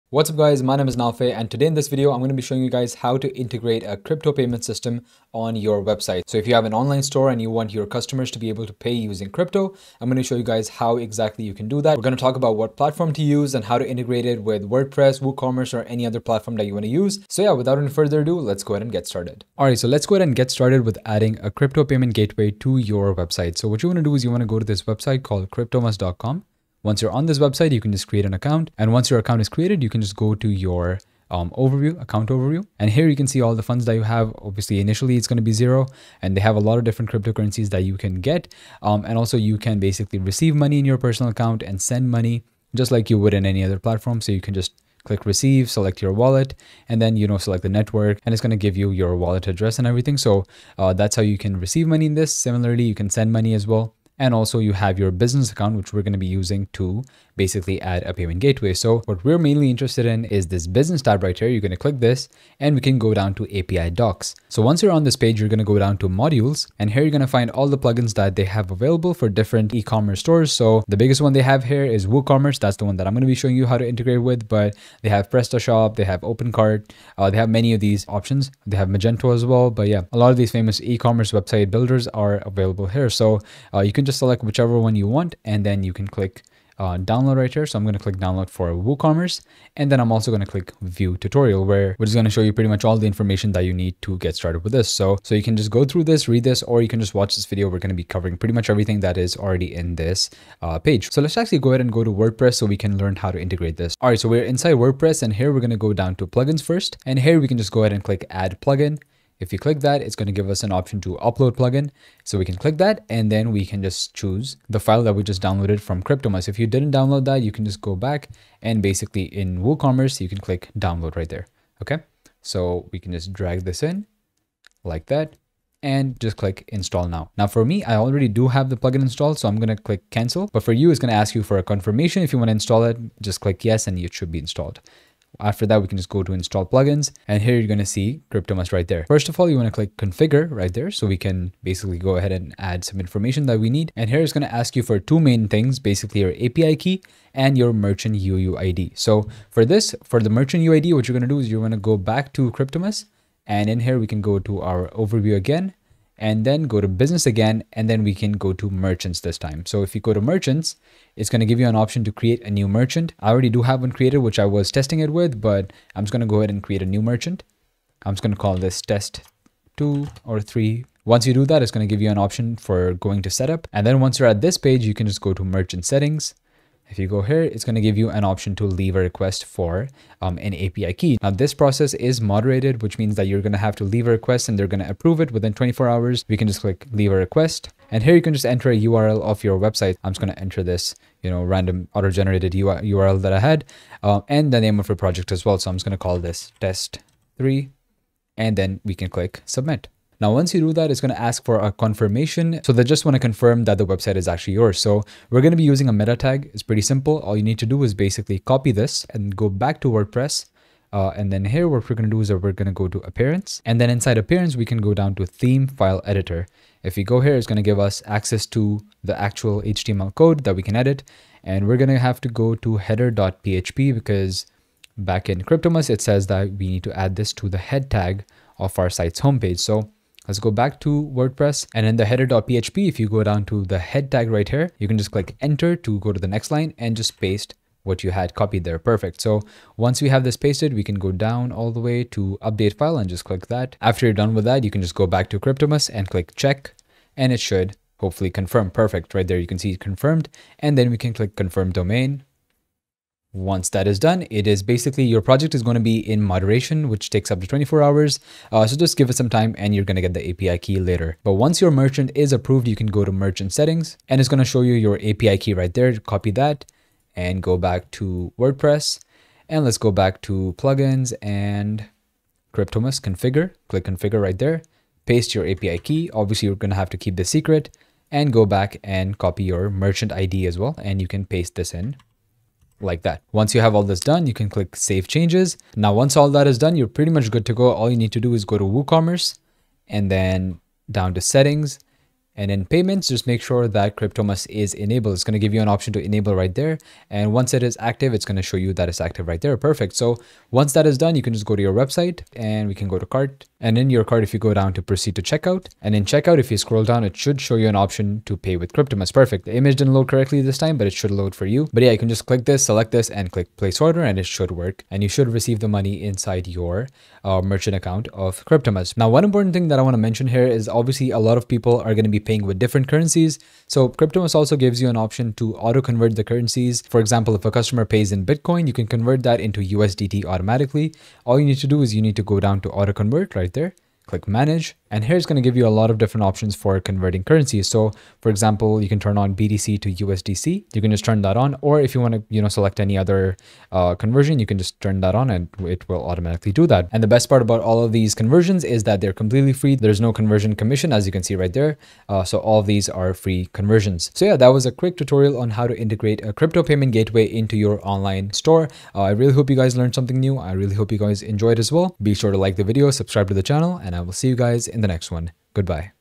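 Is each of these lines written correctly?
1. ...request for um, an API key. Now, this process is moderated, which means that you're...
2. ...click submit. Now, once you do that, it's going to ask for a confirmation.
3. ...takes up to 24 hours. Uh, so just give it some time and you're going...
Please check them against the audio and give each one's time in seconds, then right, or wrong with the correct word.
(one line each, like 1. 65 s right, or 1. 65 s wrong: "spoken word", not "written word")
1. 178 s right
2. 199 s right
3. 257 s right.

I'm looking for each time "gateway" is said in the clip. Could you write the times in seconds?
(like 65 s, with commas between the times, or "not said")
22 s, 58 s, 356 s.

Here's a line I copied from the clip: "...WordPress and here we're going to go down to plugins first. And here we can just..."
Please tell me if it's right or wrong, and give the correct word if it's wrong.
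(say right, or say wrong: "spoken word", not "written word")
right.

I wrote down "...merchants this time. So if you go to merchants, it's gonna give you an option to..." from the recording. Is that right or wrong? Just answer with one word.
right.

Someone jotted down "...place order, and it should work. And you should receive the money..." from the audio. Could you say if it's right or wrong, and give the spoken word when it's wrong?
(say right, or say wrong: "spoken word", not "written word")
right.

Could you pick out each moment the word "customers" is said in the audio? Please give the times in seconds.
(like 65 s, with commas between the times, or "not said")
7 s, 327 s.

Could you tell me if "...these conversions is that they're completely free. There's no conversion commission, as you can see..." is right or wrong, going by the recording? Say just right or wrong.
right.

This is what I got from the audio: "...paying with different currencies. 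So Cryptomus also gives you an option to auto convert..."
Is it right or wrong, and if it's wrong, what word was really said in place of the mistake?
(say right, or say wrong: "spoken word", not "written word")
right.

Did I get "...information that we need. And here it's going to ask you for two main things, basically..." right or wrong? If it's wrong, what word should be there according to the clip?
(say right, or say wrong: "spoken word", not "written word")
right.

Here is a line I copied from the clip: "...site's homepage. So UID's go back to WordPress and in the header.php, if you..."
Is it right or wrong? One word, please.
wrong.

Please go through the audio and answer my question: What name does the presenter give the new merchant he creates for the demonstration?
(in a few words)
test two or three.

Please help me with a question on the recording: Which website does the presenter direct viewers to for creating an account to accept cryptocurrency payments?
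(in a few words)
cryptomus.com.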